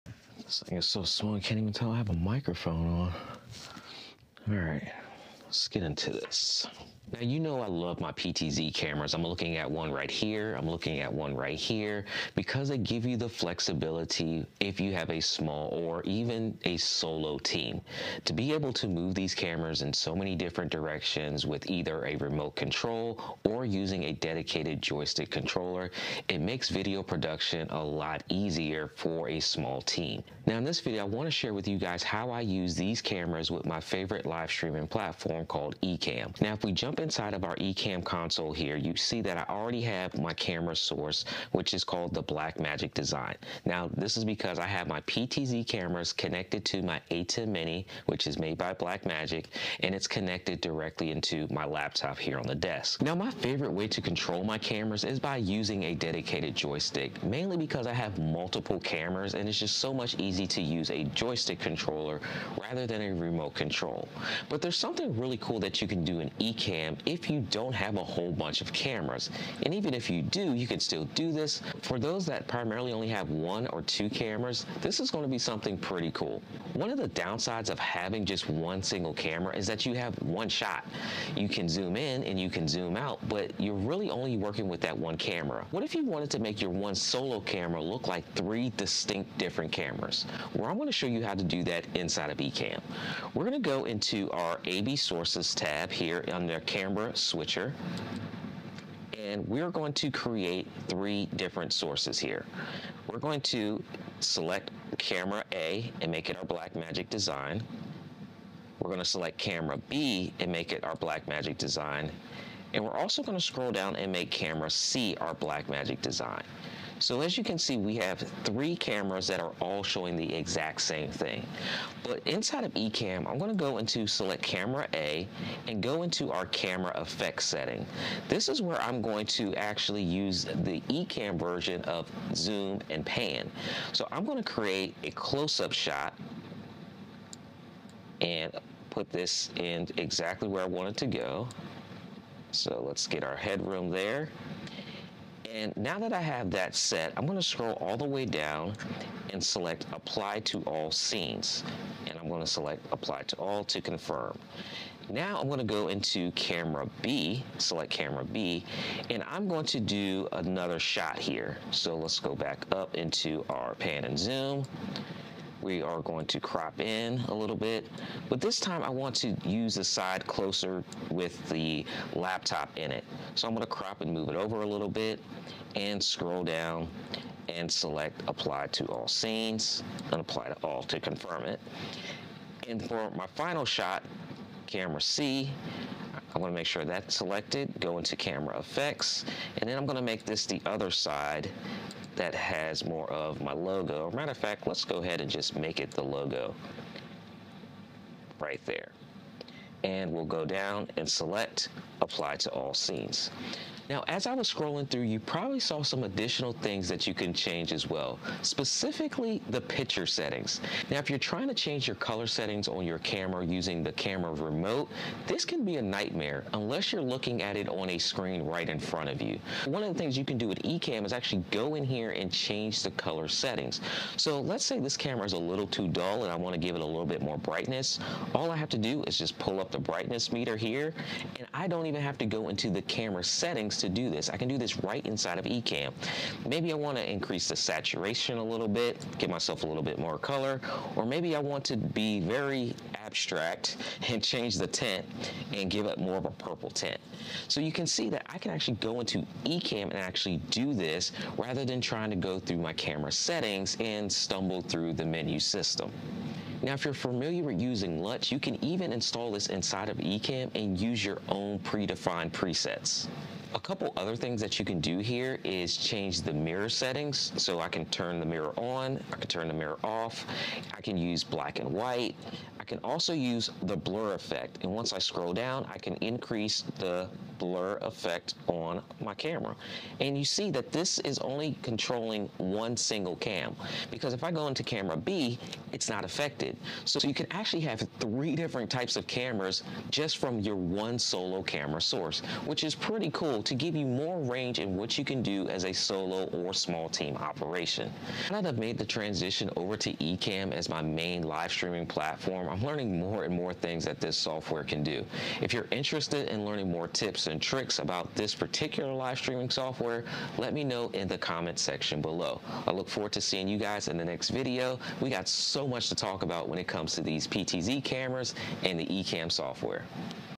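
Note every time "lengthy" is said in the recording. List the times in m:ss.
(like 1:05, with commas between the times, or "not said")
not said.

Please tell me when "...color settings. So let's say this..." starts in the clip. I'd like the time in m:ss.
3:42.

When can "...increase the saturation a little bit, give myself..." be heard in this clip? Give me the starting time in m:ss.
3:57.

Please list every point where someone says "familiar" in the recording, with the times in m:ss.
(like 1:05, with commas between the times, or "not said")
4:16.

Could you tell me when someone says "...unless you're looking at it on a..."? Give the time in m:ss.
3:36.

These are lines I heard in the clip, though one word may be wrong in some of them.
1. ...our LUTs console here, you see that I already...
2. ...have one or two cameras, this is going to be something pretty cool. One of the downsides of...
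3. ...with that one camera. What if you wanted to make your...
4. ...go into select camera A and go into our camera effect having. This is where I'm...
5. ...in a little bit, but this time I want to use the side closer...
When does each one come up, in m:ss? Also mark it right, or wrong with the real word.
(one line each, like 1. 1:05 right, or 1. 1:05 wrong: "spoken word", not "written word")
1. 0:37 wrong: "Ecamm", not "LUTs"
2. 1:13 right
3. 1:24 right
4. 2:03 wrong: "setting", not "having"
5. 2:46 right.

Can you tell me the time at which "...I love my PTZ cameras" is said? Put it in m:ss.
0:07.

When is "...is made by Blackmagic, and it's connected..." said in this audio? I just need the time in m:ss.
0:48.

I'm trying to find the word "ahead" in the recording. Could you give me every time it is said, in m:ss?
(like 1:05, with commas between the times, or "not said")
3:14.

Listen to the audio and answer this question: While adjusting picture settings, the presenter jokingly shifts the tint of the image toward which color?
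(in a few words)
purple.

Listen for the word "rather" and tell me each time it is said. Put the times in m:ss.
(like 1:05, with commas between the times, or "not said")
1:02, 4:11.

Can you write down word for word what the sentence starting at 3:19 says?
And we'll go down and select apply to all scenes.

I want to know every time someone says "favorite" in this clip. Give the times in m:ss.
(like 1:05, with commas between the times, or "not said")
0:33, 0:53.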